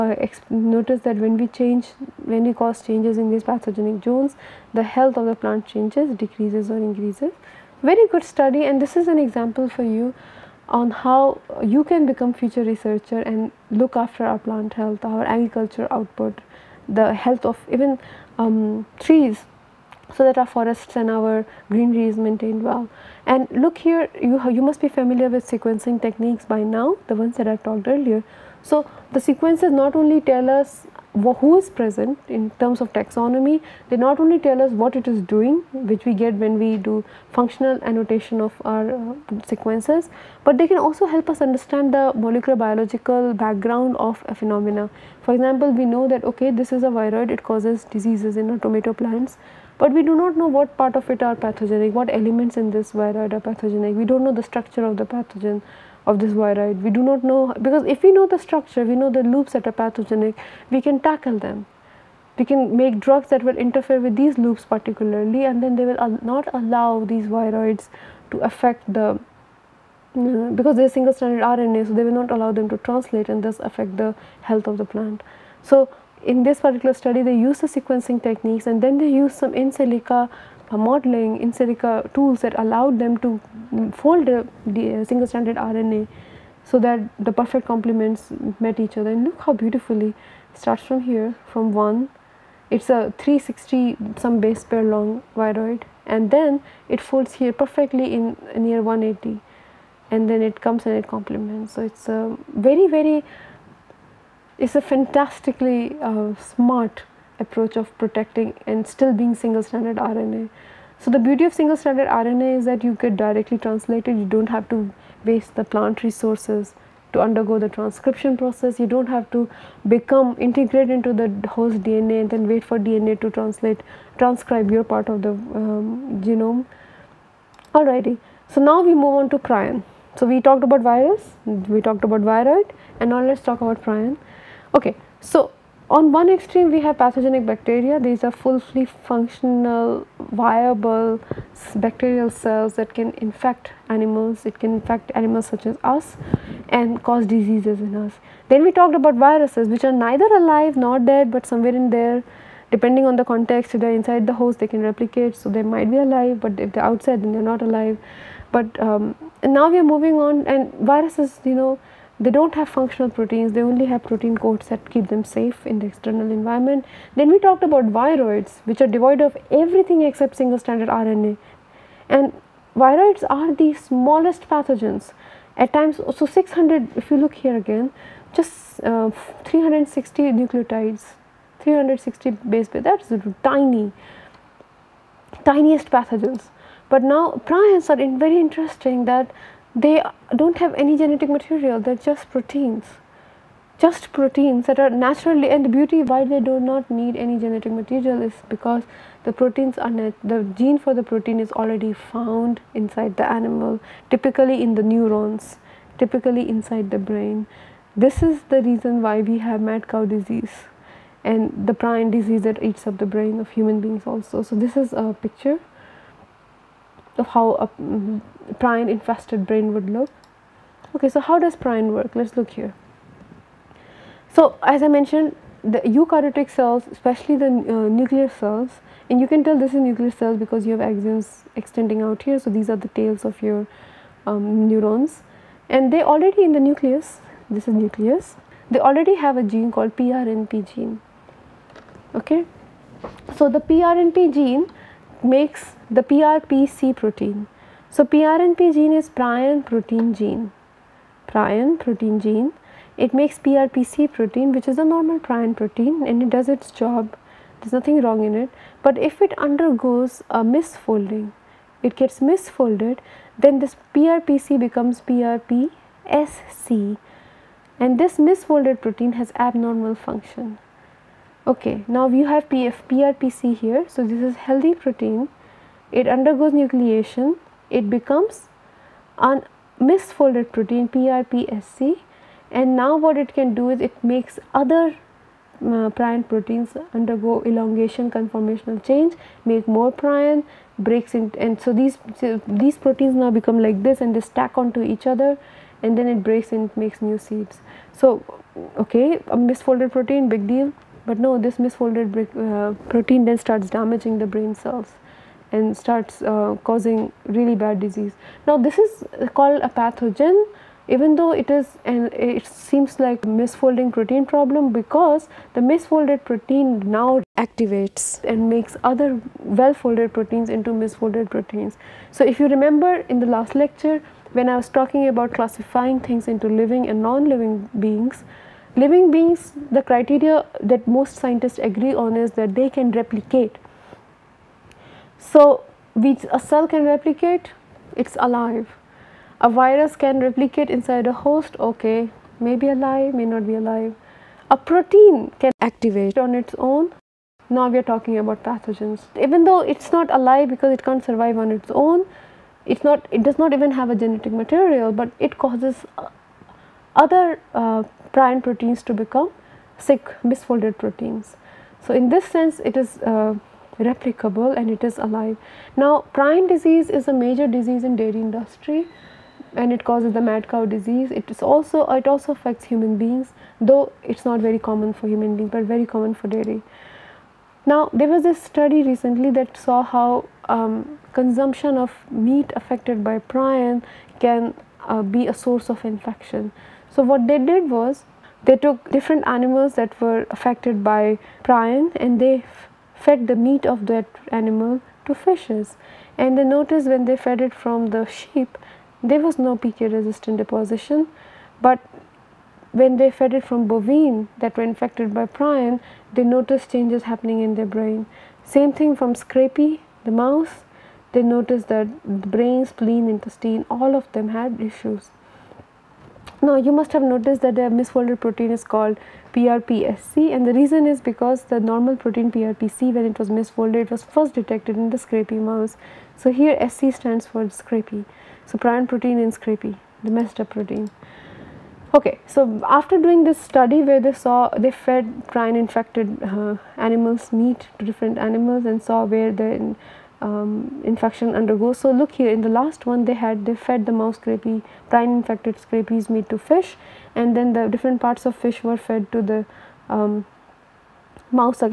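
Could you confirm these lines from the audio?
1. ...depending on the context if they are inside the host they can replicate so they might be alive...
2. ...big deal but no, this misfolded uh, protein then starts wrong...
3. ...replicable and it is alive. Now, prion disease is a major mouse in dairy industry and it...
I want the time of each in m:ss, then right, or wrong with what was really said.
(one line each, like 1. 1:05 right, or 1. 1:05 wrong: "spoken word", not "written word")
1. 2:32 right
2. 5:00 wrong: "damaging", not "wrong"
3. 6:03 wrong: "disease", not "mouse".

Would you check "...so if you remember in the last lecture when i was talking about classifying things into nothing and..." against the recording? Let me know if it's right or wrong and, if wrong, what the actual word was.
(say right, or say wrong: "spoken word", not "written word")
wrong: "living", not "nothing".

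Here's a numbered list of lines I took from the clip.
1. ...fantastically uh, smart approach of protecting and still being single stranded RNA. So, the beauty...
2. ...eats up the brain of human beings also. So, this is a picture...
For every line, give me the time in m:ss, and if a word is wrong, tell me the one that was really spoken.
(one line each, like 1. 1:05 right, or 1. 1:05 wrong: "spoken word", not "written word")
1. 1:44 right
2. 3:32 right.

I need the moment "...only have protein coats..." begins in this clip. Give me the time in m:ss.
2:43.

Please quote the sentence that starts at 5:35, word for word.
So, we, a cell can replicate, it's alive.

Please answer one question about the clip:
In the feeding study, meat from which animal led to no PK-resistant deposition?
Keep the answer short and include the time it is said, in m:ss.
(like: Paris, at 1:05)
sheep, at 6:38.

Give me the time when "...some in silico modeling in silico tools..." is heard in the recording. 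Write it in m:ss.
1:19.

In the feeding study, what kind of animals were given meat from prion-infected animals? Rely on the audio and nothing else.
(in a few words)
fishes.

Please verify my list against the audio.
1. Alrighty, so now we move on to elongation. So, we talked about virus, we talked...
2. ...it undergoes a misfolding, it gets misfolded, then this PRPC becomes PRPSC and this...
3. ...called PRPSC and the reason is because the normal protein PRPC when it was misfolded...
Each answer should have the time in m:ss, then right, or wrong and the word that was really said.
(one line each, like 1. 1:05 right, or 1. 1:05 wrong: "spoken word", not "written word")
1. 2:07 wrong: "prion", not "elongation"
2. 4:19 right
3. 6:58 right.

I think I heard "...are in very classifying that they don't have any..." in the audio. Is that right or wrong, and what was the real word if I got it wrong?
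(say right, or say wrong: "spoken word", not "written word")
wrong: "interesting", not "classifying".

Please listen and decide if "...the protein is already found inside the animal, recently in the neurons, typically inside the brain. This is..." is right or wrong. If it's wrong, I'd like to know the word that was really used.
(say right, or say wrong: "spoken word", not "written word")
wrong: "typically", not "recently".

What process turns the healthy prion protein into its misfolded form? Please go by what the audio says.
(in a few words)
nucleation.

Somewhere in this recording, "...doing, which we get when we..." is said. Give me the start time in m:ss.
0:35.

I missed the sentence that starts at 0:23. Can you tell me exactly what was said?
And look here, you, you must be familiar with sequencing techniques by now, the ones that I talked earlier.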